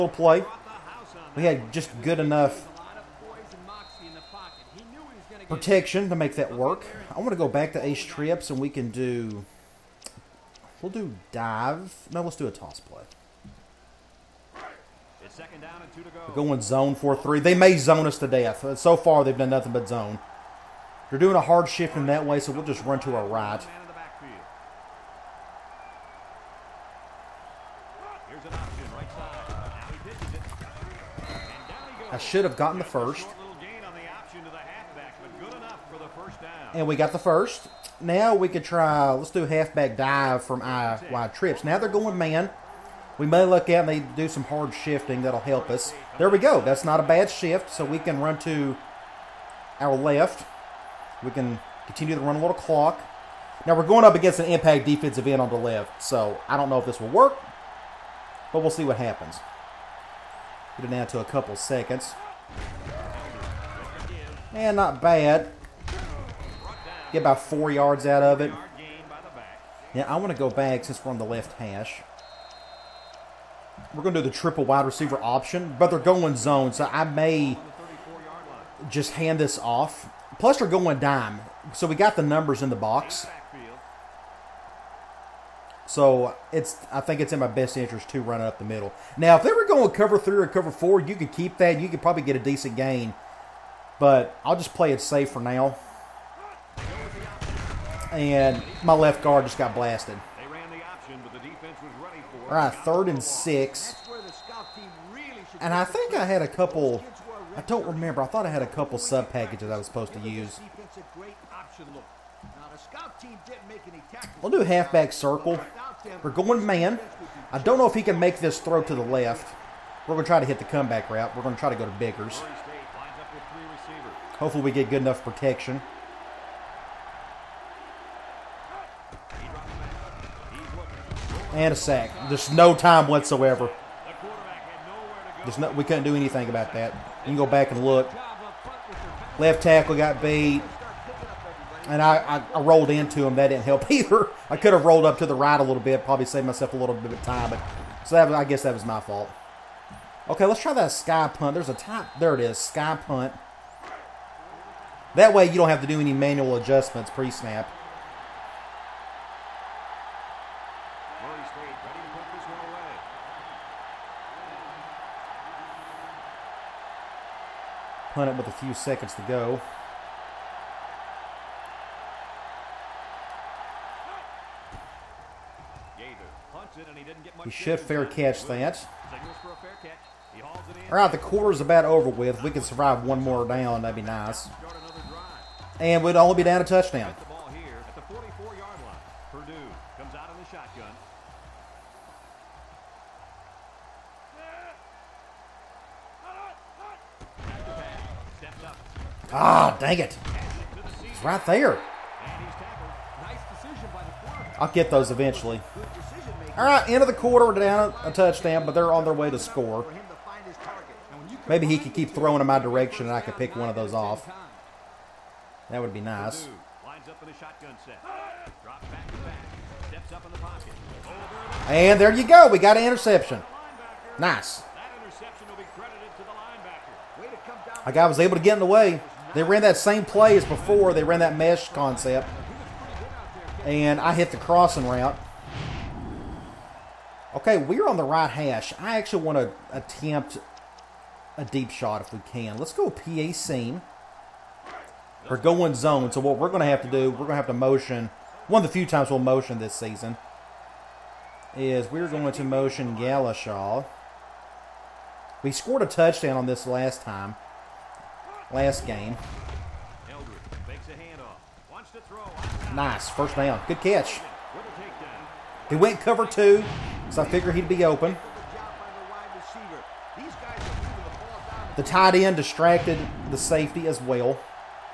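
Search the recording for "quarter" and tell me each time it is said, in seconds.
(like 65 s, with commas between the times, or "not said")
181 s, 207 s.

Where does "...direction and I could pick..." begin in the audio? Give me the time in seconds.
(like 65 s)
212 s.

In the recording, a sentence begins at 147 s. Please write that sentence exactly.
But so that I guess that was my fault.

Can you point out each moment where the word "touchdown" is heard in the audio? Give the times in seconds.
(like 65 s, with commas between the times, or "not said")
186 s, 208 s, 255 s.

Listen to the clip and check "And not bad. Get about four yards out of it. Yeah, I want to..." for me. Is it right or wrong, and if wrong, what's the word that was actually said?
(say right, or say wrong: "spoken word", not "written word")
right.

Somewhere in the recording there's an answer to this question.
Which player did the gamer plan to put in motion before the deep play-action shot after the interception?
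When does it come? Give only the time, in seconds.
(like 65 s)
252 s.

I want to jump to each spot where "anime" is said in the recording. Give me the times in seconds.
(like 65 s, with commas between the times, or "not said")
not said.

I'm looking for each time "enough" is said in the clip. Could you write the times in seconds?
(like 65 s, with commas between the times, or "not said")
2 s, 125 s.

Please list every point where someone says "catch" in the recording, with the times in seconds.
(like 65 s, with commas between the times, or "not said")
178 s, 263 s.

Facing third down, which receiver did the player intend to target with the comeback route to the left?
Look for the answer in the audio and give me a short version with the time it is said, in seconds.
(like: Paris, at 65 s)
Bickers, at 121 s.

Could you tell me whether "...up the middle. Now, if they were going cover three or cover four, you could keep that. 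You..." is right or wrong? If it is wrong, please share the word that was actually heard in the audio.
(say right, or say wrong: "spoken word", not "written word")
right.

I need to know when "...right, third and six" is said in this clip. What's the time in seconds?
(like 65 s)
102 s.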